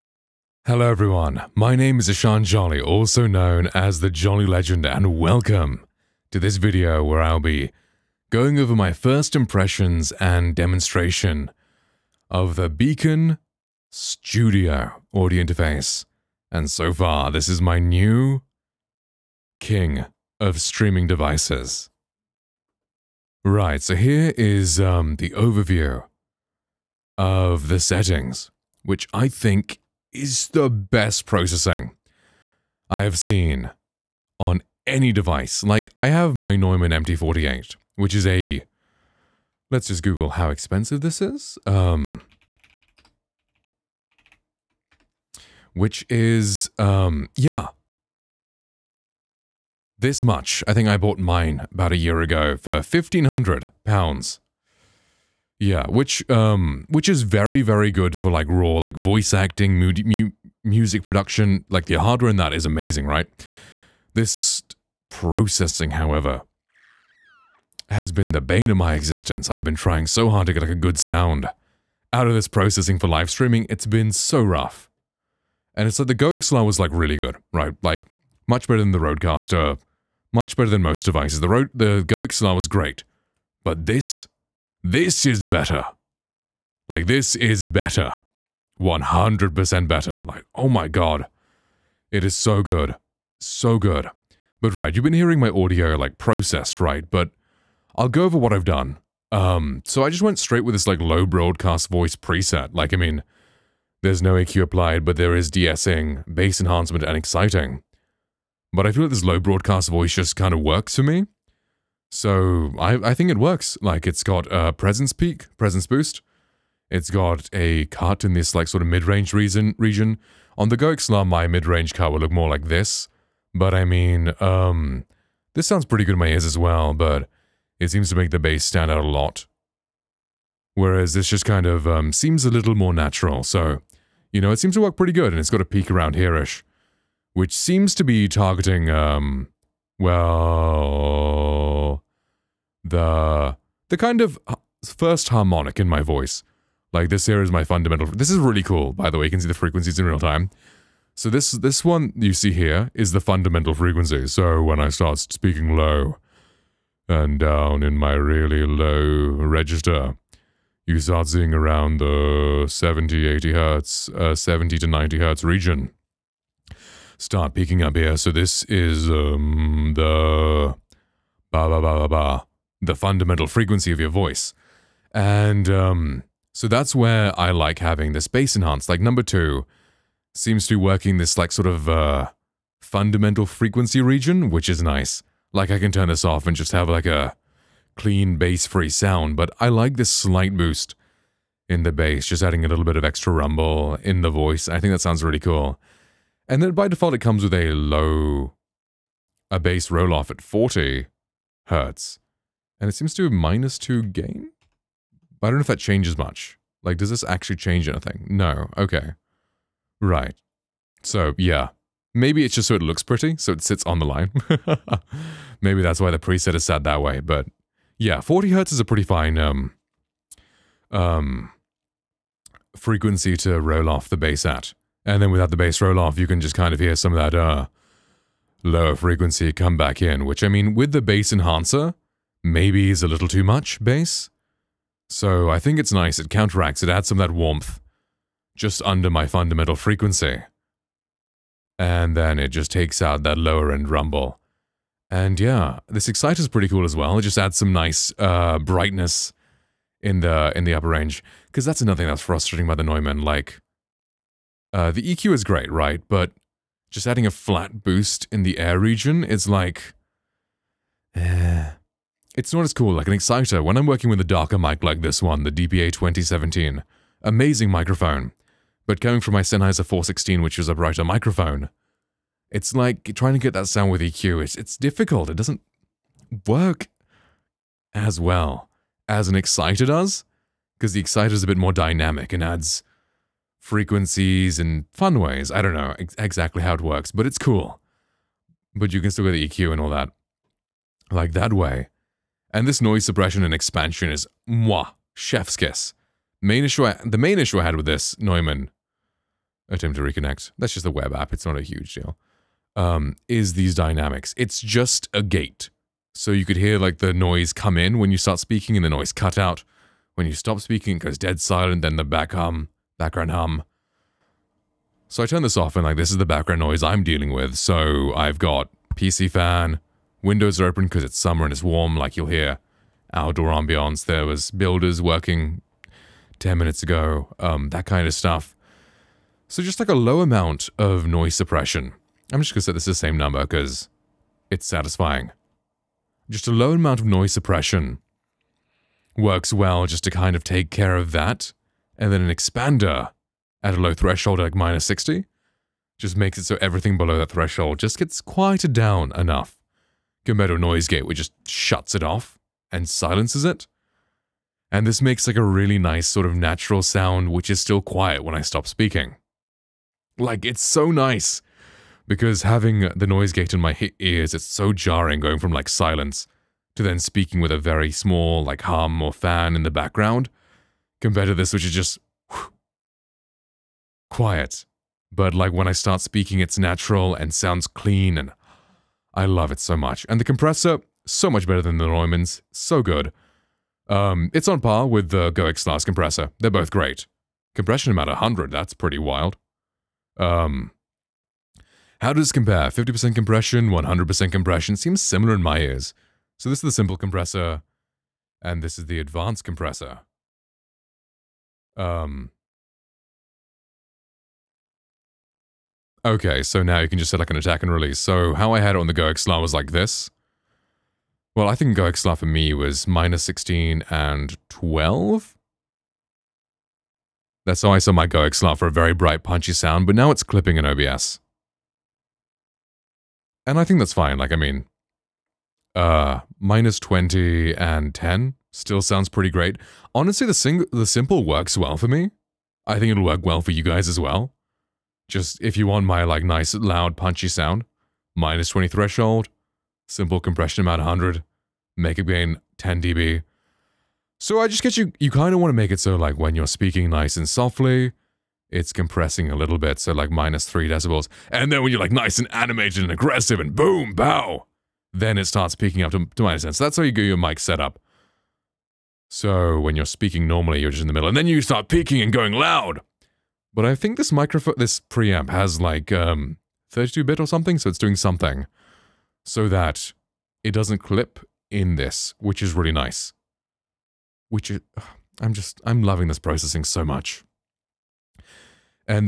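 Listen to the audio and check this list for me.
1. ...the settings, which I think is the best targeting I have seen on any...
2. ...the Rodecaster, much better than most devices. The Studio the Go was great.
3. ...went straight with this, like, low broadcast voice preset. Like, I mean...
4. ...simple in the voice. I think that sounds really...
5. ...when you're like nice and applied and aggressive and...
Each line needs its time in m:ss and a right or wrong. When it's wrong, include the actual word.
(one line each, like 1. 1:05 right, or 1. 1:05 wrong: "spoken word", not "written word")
1. 0:27 wrong: "processing", not "targeting"
2. 1:18 wrong: "Rode", not "Studio"
3. 1:40 right
4. 3:13 wrong: "rumble", not "simple"
5. 7:31 wrong: "animated", not "applied".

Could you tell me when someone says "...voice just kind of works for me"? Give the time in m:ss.
1:49.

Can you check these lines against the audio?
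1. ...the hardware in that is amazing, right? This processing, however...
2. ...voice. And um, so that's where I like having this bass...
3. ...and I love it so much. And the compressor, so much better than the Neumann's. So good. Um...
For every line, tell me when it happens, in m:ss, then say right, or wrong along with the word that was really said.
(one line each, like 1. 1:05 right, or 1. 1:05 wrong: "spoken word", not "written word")
1. 1:01 right
2. 2:54 right
3. 6:18 right.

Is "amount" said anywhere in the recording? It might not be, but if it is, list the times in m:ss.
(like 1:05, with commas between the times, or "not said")
5:30, 5:36, 6:27.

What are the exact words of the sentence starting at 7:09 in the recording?
Honestly, the, sing the simple works well for me.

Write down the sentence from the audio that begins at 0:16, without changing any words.
And so far, this is my new king of streaming devices.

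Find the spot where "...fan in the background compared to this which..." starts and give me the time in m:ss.
6:09.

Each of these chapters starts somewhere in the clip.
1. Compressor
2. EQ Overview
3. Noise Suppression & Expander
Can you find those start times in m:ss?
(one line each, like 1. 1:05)
1. 6:19
2. 1:39
3. 4:51.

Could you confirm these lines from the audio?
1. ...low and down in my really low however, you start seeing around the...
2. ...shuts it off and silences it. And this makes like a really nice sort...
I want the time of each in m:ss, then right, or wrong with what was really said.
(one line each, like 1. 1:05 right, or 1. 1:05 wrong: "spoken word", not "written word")
1. 2:35 wrong: "register", not "however"
2. 5:51 right.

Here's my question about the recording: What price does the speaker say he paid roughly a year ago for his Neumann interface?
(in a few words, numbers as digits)
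£1,500.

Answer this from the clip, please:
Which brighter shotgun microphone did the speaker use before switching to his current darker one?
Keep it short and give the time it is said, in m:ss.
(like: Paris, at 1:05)
Sennheiser 416, at 4:29.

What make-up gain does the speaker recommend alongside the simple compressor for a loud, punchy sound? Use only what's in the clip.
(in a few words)
10 dB.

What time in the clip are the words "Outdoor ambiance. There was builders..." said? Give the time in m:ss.
5:23.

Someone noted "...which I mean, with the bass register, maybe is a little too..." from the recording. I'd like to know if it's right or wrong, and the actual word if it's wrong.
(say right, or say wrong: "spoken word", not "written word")
wrong: "enhancer", not "register".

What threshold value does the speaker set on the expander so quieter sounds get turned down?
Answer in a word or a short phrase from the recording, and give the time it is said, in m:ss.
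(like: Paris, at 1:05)
-60, at 5:44.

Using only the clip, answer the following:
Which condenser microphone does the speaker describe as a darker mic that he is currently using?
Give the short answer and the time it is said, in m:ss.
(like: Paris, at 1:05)
DPA 2017, at 4:25.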